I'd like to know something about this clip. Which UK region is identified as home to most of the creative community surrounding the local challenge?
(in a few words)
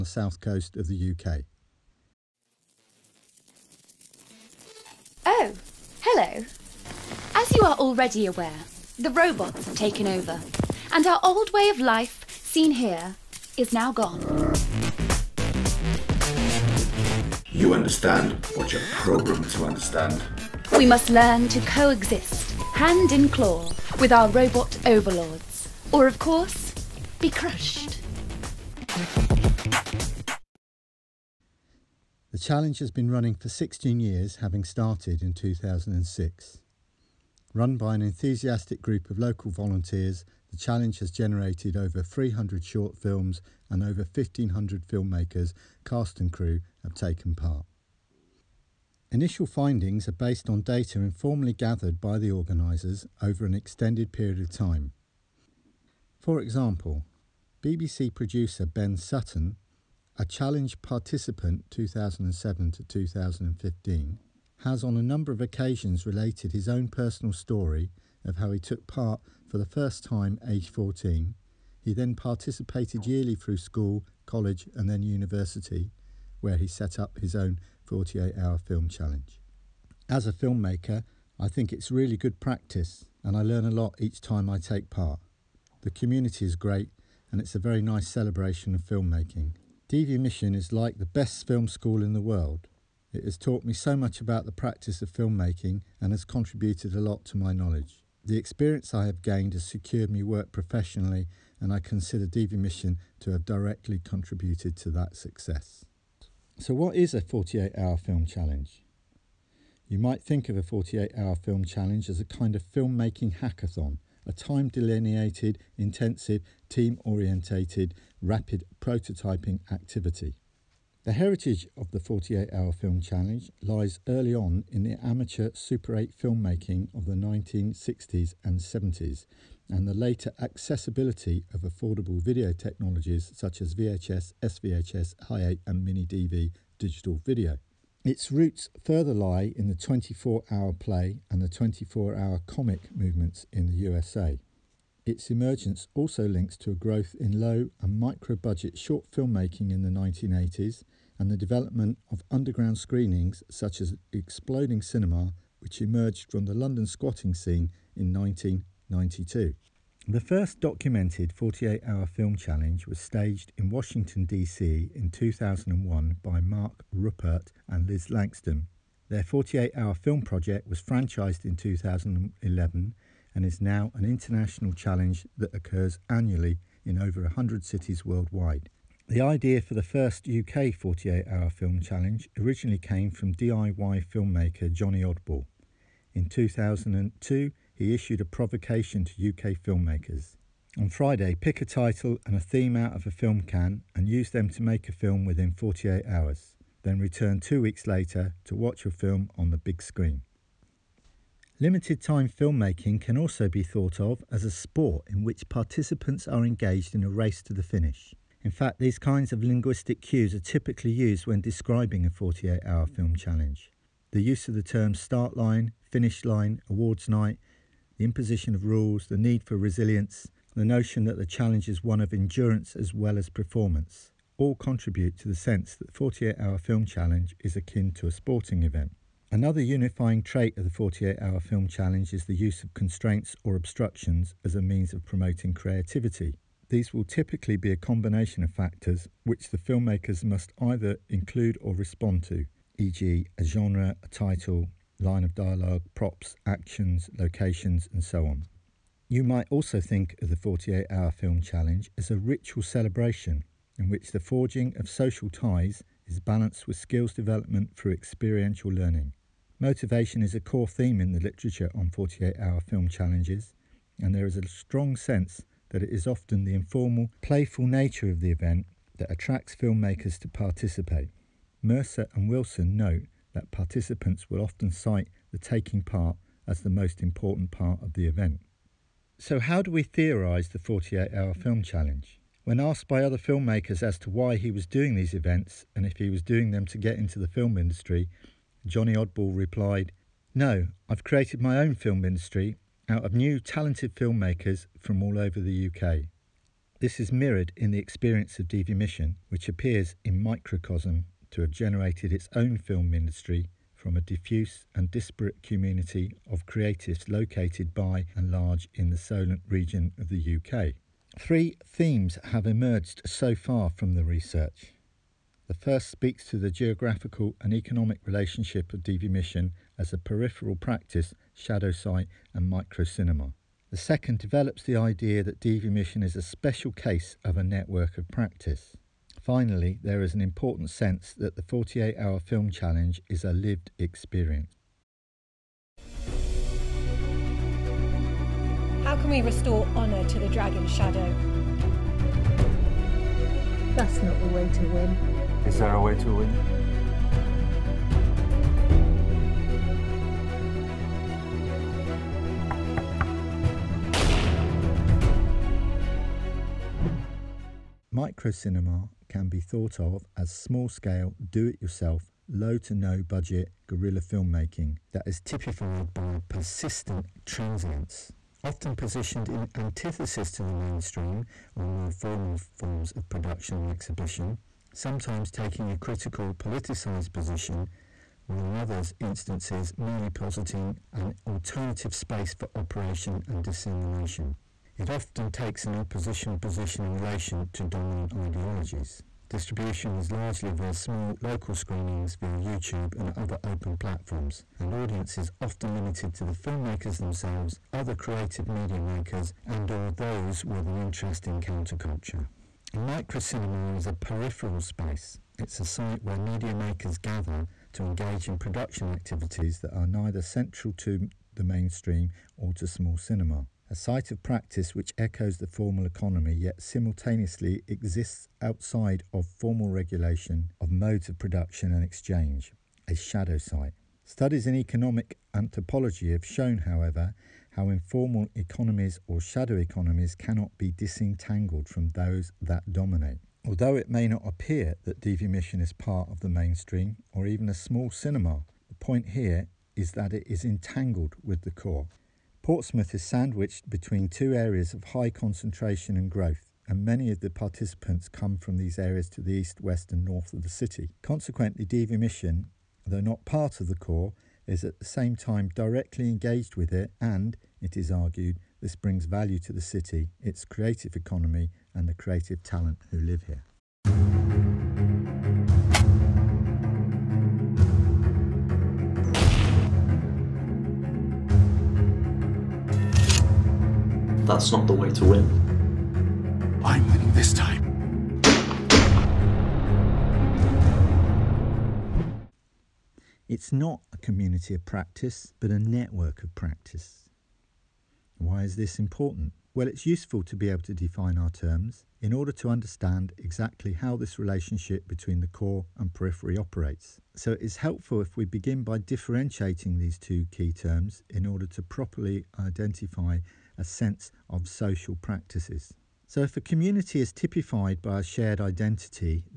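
Solent.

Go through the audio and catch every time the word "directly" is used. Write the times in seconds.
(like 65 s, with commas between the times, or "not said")
103 s, 455 s.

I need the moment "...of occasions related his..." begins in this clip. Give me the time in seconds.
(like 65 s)
65 s.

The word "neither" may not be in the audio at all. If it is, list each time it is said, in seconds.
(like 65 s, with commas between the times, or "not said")
409 s.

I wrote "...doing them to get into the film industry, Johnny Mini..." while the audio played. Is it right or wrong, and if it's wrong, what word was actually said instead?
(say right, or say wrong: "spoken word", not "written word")
wrong: "Oddball", not "Mini".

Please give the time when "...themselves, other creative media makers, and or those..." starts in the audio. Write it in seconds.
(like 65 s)
396 s.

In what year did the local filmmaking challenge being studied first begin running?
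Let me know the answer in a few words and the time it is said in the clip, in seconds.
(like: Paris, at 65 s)
2006, at 35 s.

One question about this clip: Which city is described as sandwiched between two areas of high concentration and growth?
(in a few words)
Portsmouth.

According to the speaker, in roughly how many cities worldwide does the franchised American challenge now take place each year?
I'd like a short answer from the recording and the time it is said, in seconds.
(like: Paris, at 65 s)
over 100, at 177 s.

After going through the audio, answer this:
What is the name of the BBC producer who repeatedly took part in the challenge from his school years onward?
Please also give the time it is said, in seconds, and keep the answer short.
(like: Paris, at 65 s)
Ben Sutton, at 58 s.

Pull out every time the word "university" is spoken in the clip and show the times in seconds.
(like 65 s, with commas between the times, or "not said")
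75 s.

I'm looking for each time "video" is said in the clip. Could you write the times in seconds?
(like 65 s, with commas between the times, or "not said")
132 s, 137 s.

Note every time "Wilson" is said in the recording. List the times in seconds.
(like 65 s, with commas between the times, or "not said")
272 s.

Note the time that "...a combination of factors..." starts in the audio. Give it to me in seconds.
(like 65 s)
237 s.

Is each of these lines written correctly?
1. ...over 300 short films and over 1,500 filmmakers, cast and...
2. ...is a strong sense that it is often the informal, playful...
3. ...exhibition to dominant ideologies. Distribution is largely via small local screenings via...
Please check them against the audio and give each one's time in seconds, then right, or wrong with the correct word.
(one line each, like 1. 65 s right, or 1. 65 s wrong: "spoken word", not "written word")
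1. 41 s right
2. 264 s right
3. 386 s wrong: "relation", not "exhibition".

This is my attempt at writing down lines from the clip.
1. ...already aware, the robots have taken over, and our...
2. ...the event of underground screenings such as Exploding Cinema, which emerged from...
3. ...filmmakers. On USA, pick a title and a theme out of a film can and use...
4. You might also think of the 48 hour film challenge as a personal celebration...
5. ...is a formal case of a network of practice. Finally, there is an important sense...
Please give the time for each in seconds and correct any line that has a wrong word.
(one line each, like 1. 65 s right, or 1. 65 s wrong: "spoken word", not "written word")
1. 7 s right
2. 151 s wrong: "development", not "event"
3. 189 s wrong: "Friday", not "USA"
4. 249 s wrong: "ritual", not "personal"
5. 326 s wrong: "special", not "formal".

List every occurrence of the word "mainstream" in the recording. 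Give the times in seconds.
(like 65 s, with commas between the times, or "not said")
370 s, 411 s, 436 s.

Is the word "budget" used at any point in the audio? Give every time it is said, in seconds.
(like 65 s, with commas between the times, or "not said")
147 s, 363 s.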